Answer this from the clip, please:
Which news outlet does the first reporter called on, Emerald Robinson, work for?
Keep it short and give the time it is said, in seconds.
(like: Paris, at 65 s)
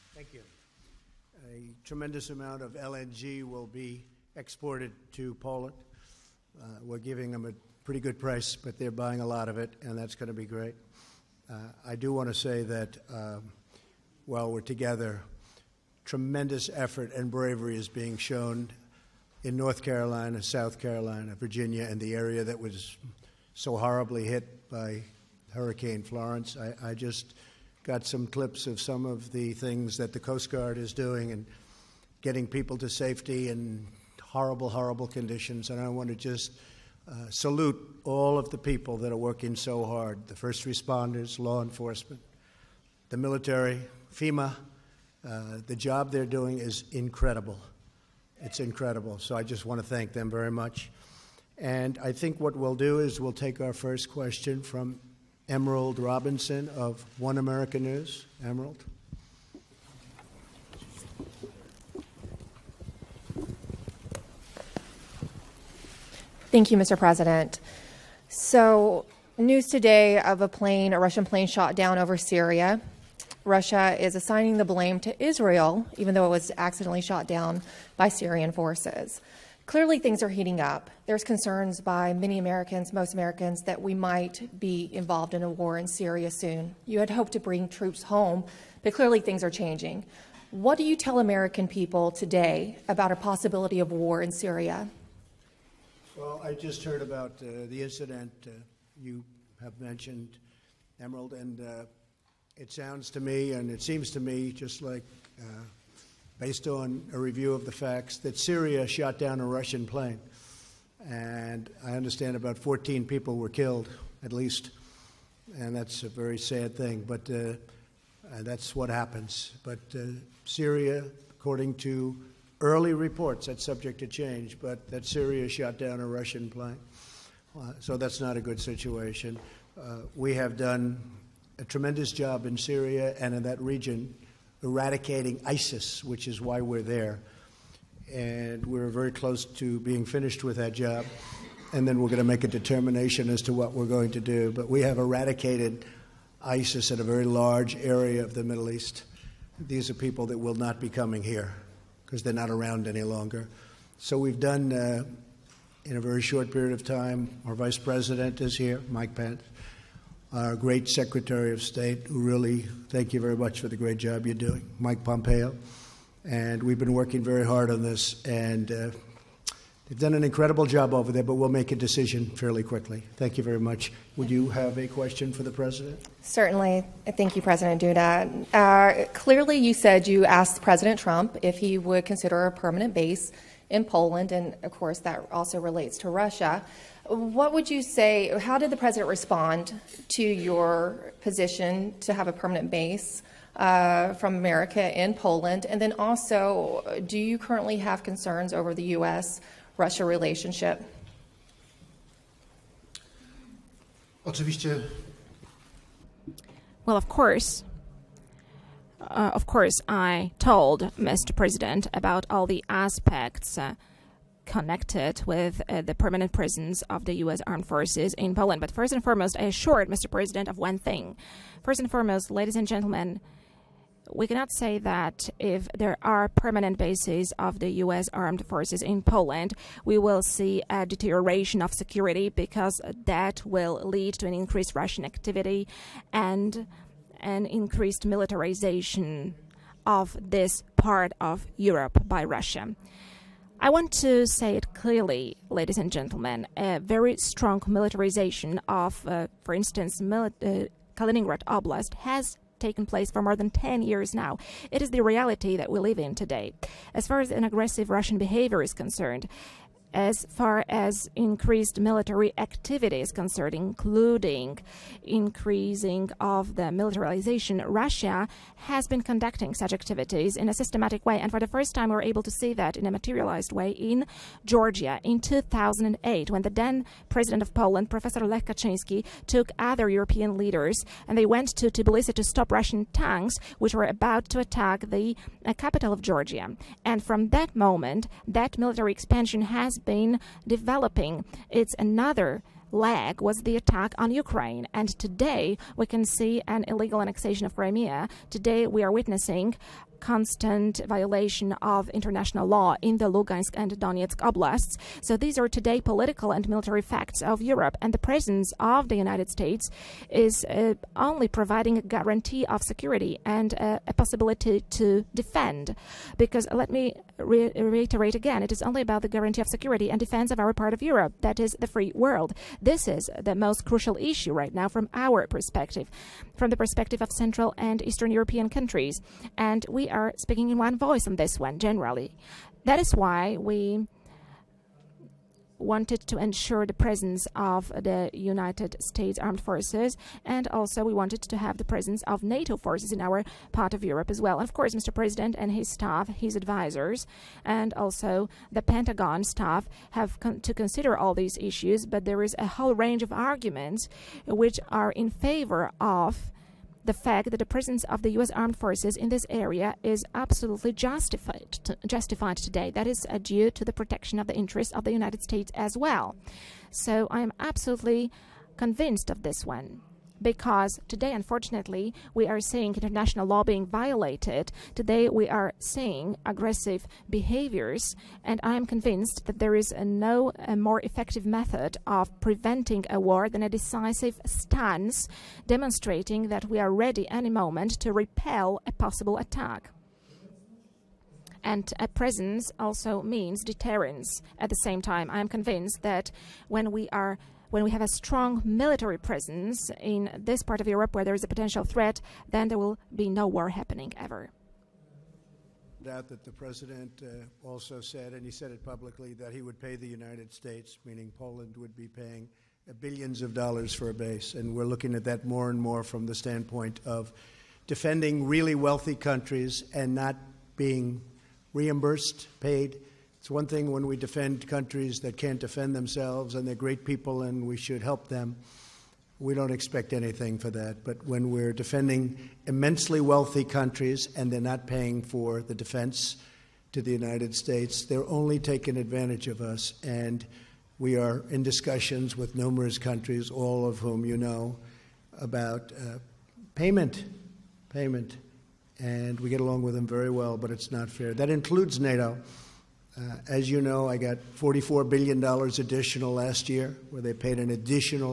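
One American News, at 57 s.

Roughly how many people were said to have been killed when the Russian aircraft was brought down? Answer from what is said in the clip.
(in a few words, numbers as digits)
14.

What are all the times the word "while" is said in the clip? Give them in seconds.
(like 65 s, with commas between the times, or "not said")
14 s.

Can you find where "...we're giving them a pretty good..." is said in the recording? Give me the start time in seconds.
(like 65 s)
6 s.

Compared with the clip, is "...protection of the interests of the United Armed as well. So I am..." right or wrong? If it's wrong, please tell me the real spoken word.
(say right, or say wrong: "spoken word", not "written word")
wrong: "States", not "Armed".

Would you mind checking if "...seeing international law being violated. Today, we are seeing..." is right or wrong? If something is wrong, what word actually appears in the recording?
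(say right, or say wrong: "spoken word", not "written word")
right.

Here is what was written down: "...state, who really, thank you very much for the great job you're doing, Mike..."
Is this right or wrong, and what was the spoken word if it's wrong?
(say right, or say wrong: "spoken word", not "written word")
right.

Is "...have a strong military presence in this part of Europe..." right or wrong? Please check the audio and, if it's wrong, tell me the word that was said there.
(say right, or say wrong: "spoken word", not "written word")
right.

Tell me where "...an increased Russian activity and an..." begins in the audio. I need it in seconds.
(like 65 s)
234 s.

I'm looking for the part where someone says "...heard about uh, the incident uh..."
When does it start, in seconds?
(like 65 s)
96 s.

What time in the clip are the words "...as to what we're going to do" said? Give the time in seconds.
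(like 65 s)
143 s.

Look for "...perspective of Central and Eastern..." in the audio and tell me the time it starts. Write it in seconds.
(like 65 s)
326 s.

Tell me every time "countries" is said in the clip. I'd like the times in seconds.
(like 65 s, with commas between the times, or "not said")
328 s, 418 s, 424 s, 433 s, 442 s.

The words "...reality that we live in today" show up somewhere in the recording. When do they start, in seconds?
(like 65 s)
255 s.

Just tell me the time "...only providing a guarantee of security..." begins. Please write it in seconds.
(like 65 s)
310 s.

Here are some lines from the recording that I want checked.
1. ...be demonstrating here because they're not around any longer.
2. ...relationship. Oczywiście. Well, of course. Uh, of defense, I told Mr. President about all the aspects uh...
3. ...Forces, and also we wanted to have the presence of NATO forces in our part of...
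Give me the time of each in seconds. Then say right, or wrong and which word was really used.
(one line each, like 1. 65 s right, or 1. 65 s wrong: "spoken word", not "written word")
1. 150 s wrong: "coming", not "demonstrating"
2. 200 s wrong: "course", not "defense"
3. 339 s right.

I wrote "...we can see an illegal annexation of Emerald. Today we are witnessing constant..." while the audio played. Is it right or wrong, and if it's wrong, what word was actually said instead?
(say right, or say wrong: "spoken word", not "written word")
wrong: "Crimea", not "Emerald".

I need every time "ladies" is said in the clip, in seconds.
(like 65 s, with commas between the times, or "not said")
222 s, 245 s.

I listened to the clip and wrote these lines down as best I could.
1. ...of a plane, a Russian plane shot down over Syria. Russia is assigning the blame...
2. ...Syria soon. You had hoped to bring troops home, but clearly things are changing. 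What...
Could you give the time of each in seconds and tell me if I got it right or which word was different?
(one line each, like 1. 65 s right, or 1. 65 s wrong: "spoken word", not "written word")
1. 70 s right
2. 85 s right.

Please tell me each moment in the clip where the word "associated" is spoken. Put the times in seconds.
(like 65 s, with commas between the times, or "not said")
not said.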